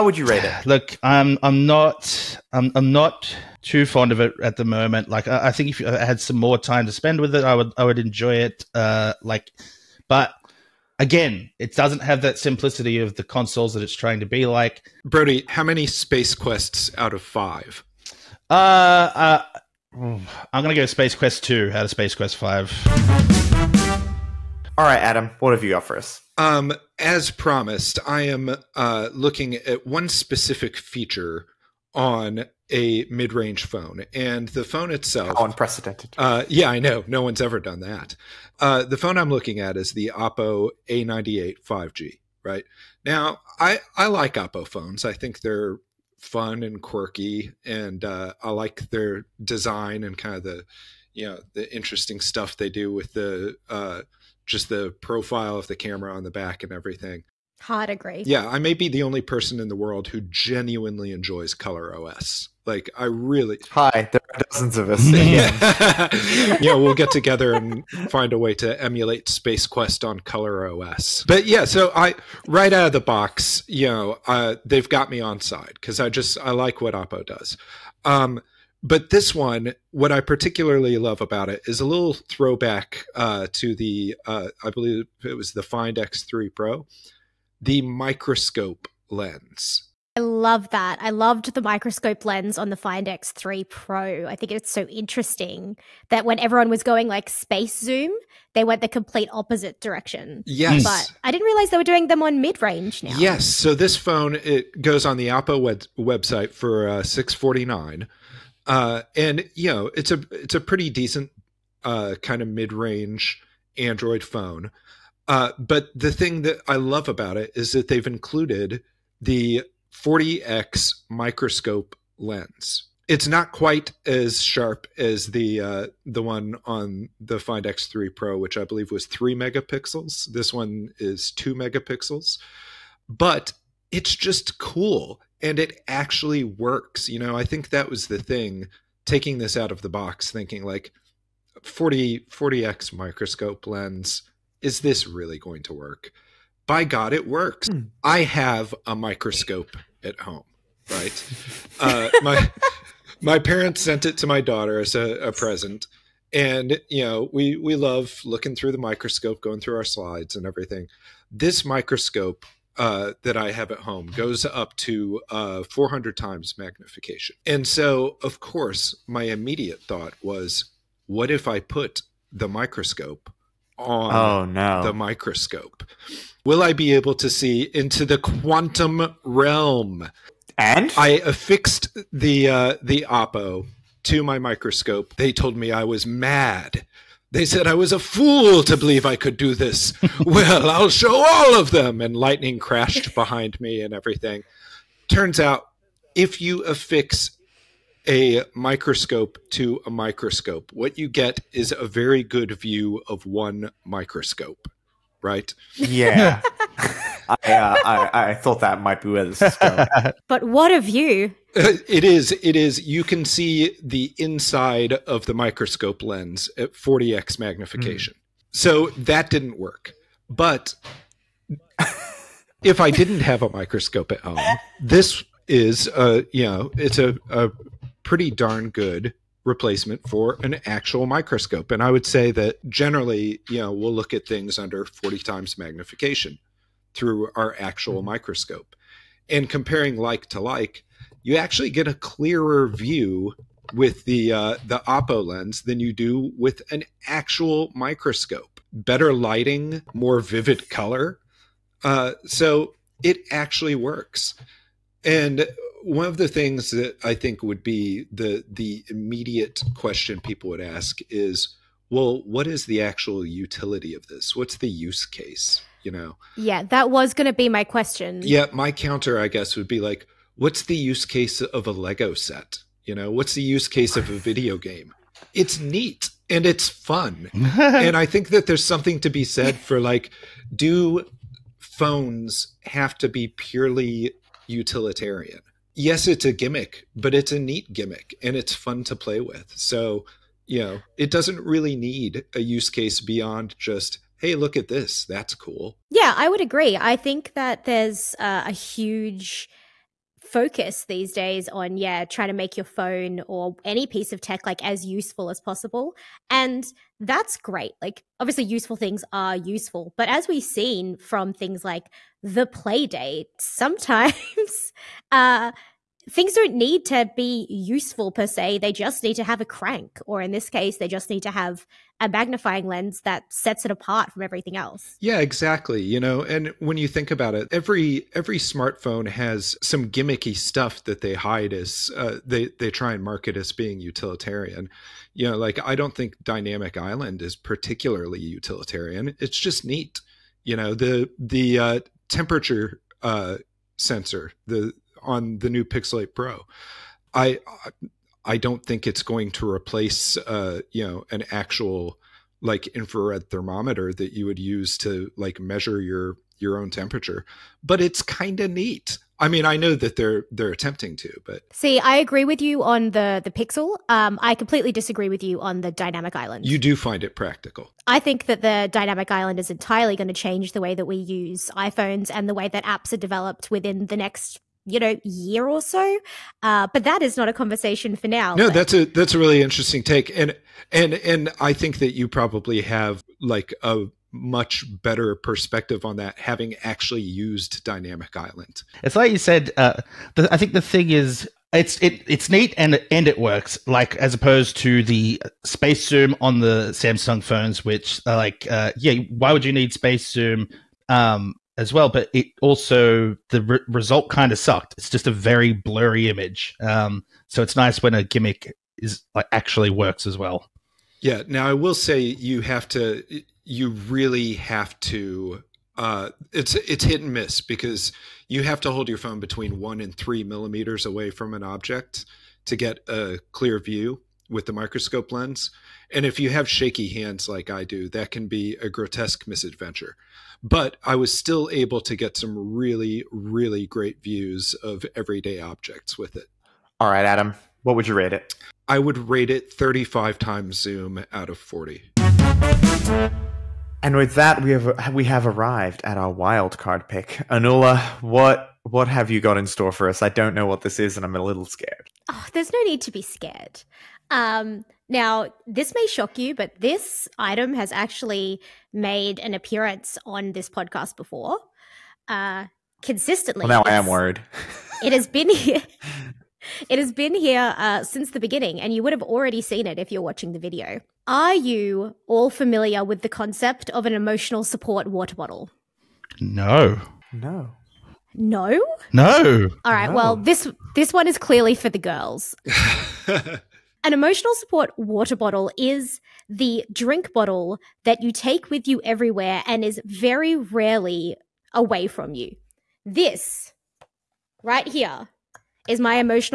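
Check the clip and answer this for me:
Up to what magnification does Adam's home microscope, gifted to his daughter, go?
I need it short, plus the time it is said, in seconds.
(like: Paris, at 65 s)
400 times, at 165 s.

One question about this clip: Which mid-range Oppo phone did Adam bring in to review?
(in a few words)
Oppo A98 5G.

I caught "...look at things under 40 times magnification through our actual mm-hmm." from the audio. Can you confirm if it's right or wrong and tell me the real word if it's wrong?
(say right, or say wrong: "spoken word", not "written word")
right.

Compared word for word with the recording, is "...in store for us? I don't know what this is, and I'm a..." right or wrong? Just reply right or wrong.
right.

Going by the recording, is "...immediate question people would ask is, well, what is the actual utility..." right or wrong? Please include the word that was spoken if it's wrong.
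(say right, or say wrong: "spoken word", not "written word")
right.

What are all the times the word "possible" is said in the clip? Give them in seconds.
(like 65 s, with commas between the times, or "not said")
305 s.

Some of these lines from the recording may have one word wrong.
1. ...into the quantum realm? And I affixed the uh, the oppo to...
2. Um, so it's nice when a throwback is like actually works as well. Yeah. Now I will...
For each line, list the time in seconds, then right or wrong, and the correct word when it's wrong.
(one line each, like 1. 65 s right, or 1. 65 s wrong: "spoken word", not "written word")
1. 177 s right
2. 406 s wrong: "gimmick", not "throwback".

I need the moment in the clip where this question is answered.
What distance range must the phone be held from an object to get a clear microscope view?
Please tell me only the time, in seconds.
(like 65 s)
419 s.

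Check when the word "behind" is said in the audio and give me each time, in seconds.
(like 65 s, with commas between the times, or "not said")
193 s.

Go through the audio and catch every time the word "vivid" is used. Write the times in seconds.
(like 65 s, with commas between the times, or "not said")
250 s.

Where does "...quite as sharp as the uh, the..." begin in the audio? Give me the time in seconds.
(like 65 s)
123 s.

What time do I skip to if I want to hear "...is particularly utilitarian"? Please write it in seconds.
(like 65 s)
337 s.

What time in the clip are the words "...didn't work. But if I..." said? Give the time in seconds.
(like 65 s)
219 s.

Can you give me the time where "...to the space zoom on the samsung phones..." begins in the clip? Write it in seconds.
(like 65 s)
394 s.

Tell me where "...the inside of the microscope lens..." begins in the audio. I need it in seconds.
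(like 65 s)
213 s.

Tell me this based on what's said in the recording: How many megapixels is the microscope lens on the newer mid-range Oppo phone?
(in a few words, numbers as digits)
2.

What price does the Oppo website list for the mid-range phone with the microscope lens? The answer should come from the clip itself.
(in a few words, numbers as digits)
649.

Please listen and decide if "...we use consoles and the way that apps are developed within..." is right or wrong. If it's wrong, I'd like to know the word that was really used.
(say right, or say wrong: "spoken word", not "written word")
wrong: "iPhones", not "consoles".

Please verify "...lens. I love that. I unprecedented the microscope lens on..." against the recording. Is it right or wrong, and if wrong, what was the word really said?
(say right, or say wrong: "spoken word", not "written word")
wrong: "loved", not "unprecedented".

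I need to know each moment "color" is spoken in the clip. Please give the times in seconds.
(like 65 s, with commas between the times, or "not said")
61 s, 70 s, 250 s.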